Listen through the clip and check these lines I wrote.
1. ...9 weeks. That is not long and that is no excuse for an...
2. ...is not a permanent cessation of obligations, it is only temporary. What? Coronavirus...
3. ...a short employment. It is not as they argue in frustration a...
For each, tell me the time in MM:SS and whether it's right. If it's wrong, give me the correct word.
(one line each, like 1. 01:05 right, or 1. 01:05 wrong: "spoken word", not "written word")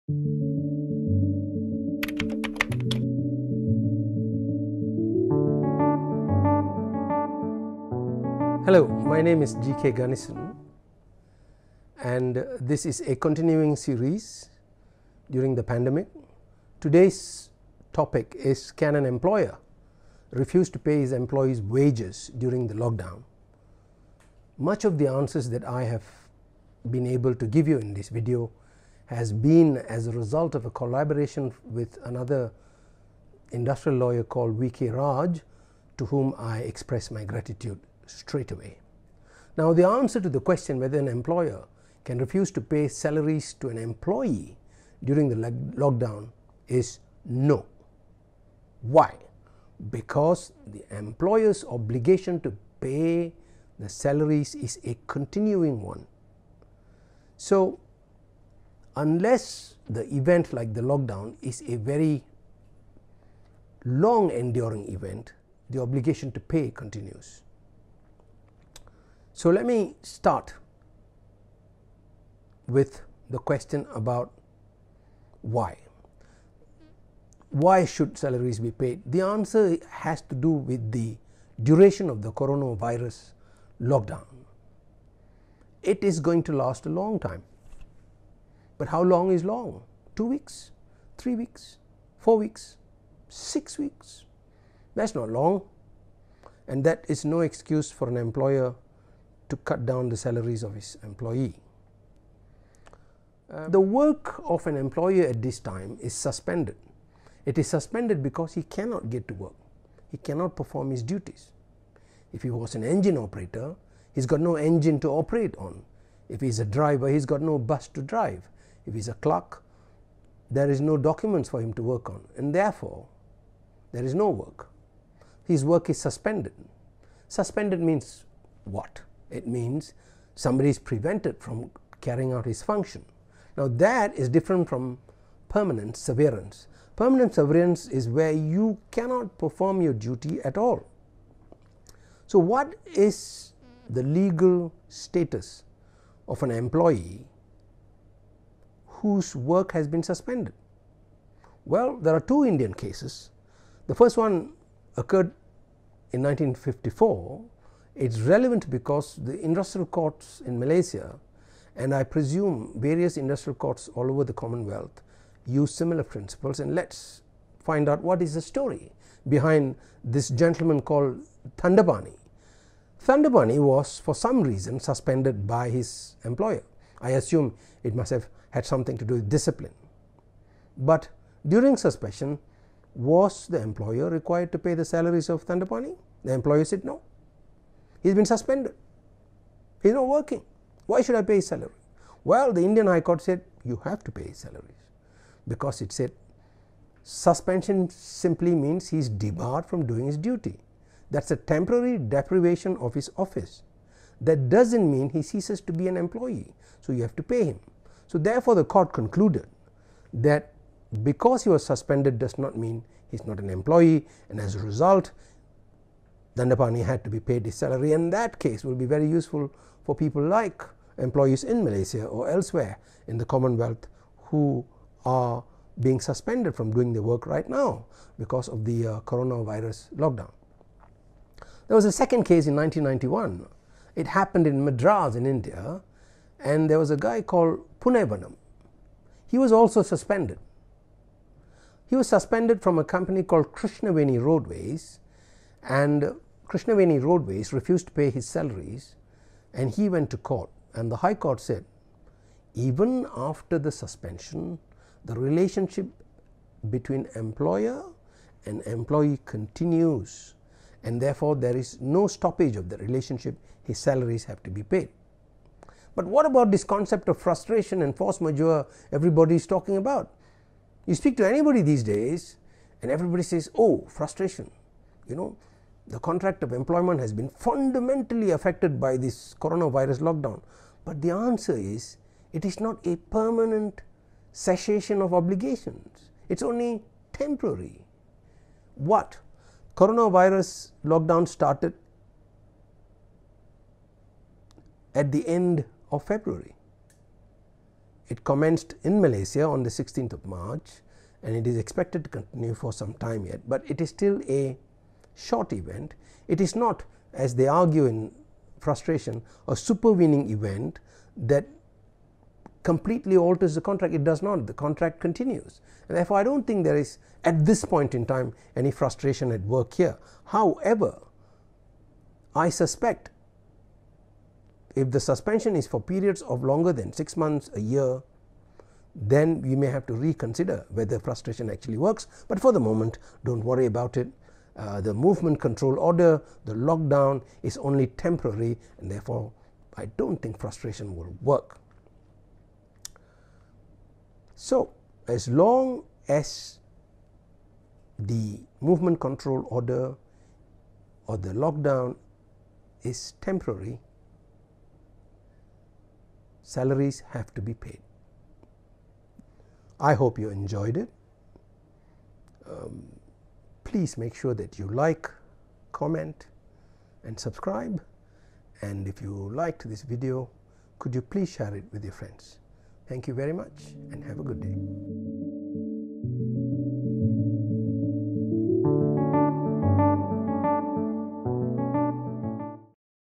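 1. 01:33 wrong: "6", not "9"
2. 04:42 right
3. 05:04 wrong: "event", not "employment".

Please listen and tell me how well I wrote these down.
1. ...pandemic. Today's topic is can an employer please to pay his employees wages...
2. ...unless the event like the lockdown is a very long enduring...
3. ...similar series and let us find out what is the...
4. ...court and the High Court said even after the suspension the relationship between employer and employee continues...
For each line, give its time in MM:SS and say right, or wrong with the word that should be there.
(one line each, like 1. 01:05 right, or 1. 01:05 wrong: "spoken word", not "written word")
1. 00:15 wrong: "refuse", not "please"
2. 00:58 right
3. 02:45 wrong: "principles", not "series"
4. 04:10 right.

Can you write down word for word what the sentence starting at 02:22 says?
So, what is the legal status of an employee whose work has been suspended?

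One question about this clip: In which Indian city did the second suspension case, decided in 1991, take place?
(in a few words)
Madras.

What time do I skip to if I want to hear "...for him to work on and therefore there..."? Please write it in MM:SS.
02:01.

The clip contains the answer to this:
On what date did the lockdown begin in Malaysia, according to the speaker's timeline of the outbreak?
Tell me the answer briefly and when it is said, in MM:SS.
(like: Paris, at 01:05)
16 March, at 04:59.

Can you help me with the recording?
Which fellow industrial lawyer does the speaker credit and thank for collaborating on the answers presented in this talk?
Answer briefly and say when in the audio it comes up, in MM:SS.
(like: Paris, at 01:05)
VK Raj, at 00:34.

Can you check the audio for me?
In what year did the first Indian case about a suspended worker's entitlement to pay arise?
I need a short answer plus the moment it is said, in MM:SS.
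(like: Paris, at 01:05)
1954, at 02:36.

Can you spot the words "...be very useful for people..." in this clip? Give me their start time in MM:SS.
03:38.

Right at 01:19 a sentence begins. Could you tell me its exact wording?
The answer has to do with the duration of the coronavirus lockdown.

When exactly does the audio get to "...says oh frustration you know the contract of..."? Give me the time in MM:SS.
04:33.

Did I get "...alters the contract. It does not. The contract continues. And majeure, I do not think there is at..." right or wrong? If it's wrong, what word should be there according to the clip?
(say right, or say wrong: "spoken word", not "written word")
wrong: "therefore", not "majeure".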